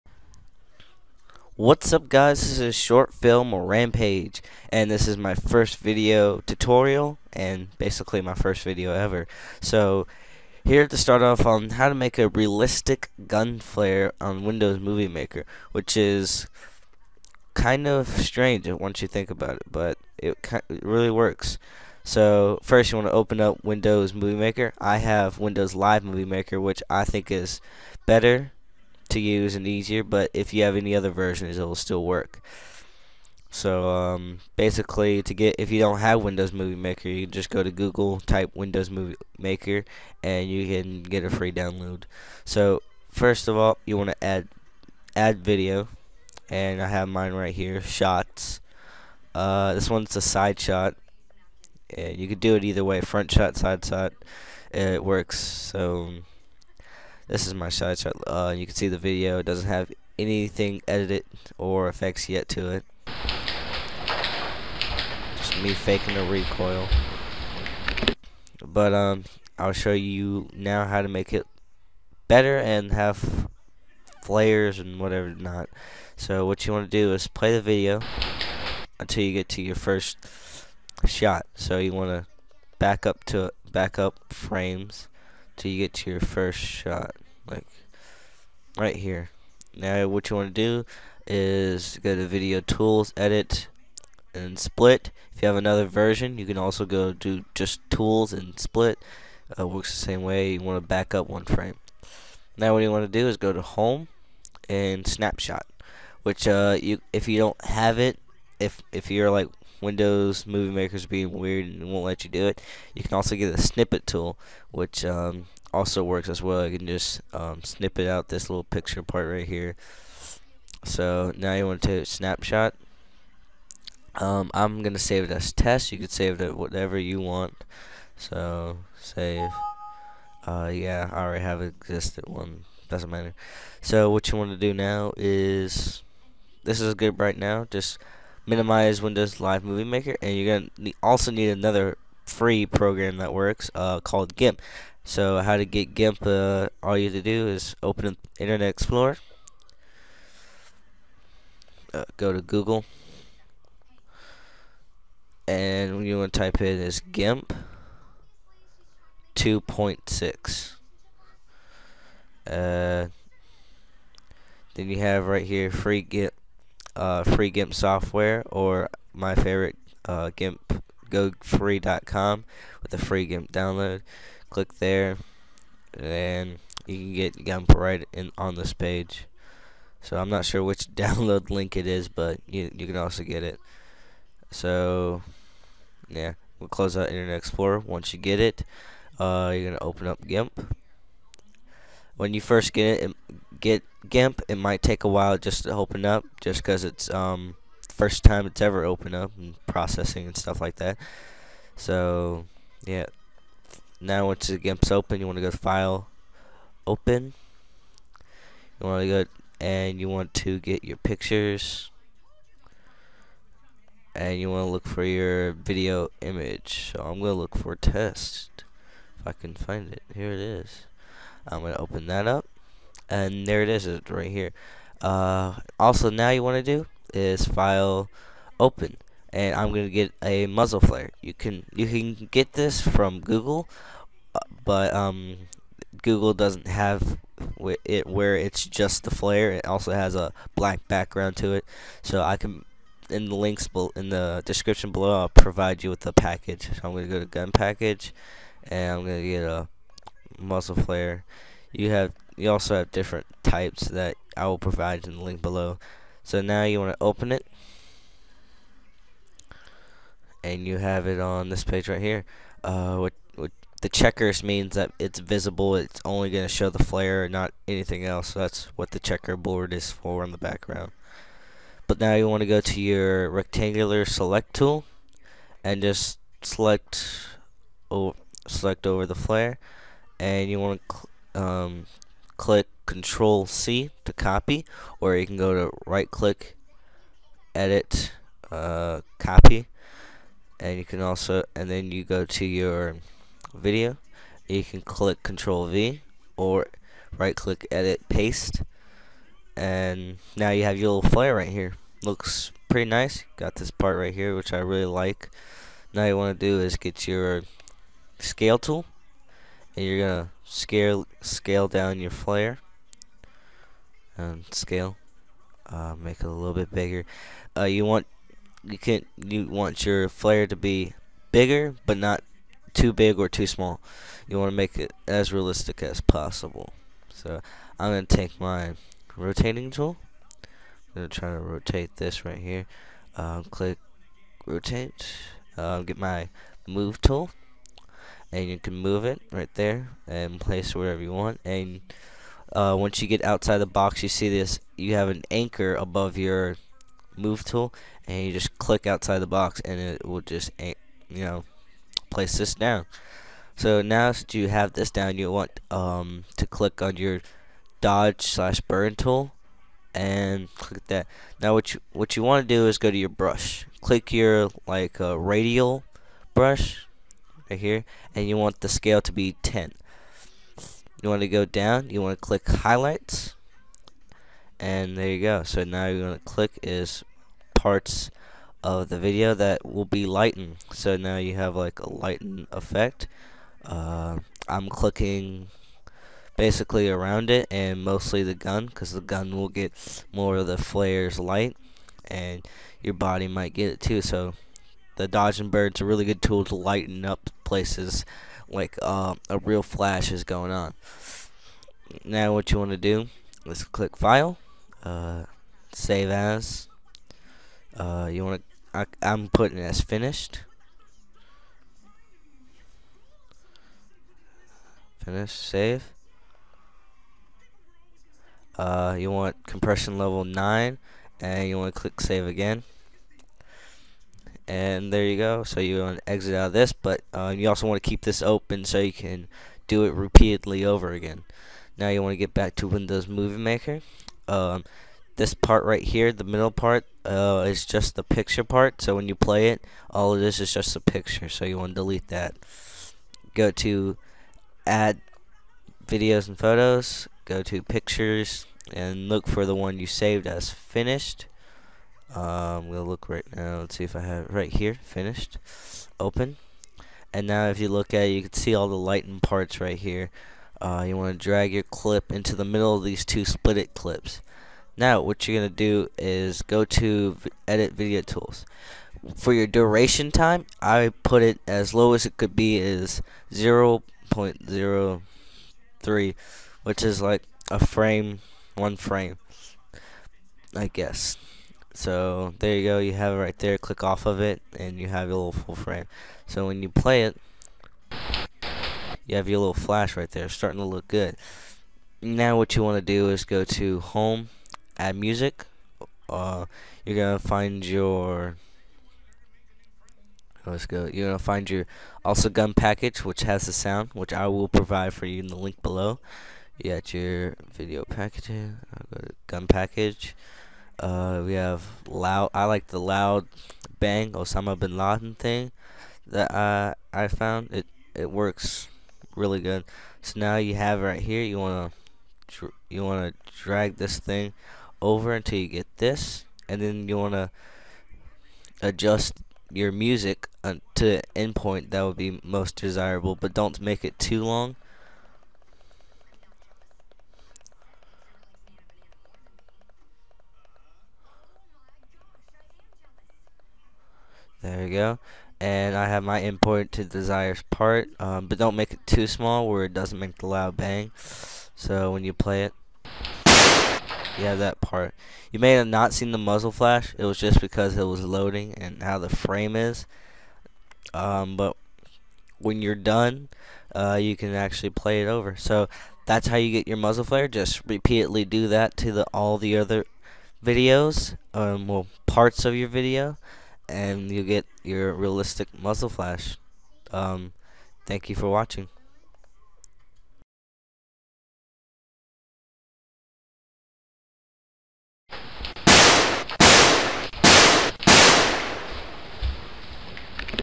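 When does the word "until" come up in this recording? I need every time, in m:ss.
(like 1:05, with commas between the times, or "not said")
1:18, 8:45.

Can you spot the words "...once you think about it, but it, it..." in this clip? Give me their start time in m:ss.
0:18.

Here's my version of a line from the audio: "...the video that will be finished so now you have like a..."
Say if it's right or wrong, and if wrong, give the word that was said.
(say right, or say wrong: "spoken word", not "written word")
wrong: "lightened", not "finished".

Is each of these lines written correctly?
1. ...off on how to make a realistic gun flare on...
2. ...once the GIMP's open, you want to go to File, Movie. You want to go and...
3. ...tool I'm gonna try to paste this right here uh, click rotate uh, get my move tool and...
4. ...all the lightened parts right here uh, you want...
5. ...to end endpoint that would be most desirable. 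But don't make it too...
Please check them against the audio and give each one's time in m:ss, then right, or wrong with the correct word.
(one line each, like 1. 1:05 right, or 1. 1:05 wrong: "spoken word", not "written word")
1. 0:11 right
2. 3:24 wrong: "Open", not "Movie"
3. 5:29 wrong: "rotate", not "paste"
4. 7:38 right
5. 8:50 right.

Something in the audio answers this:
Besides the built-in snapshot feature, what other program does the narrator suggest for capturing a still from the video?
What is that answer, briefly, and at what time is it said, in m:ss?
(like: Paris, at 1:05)
snippet tool, at 1:53.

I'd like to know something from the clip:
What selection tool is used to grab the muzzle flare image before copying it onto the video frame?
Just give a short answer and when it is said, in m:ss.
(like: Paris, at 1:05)
rectangular select tool, at 4:33.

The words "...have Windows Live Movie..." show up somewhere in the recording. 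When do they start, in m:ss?
0:24.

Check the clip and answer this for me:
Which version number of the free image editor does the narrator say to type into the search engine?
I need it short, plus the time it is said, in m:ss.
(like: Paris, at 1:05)
2.6, at 2:37.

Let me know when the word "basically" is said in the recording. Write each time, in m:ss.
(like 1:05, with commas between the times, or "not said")
0:07, 0:34, 6:26.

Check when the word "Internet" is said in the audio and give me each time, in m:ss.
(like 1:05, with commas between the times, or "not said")
2:28, 3:07.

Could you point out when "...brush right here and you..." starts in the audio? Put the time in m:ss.
6:06.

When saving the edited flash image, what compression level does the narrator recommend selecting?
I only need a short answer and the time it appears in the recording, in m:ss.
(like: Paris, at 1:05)
9, at 6:59.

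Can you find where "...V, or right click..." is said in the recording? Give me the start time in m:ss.
4:55.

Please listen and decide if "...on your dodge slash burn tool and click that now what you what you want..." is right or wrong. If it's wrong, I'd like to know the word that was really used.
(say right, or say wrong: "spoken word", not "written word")
right.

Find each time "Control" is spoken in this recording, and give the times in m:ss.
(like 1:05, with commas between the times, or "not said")
4:42, 4:55.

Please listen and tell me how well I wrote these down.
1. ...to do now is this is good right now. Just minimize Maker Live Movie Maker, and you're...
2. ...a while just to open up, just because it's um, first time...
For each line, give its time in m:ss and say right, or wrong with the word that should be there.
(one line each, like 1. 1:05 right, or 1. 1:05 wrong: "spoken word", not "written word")
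1. 2:14 wrong: "Windows", not "Maker"
2. 3:15 right.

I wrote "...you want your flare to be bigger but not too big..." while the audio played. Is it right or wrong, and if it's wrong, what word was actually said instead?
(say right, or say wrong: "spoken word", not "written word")
right.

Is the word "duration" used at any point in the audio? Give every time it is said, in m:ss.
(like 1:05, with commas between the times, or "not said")
7:49.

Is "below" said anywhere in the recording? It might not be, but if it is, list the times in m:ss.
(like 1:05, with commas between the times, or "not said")
4:04, 4:15, 8:25.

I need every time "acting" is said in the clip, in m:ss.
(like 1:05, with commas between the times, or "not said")
not said.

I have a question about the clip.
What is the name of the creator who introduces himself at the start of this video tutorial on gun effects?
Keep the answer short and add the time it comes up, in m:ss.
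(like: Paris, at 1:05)
Short Film Rampage, at 0:02.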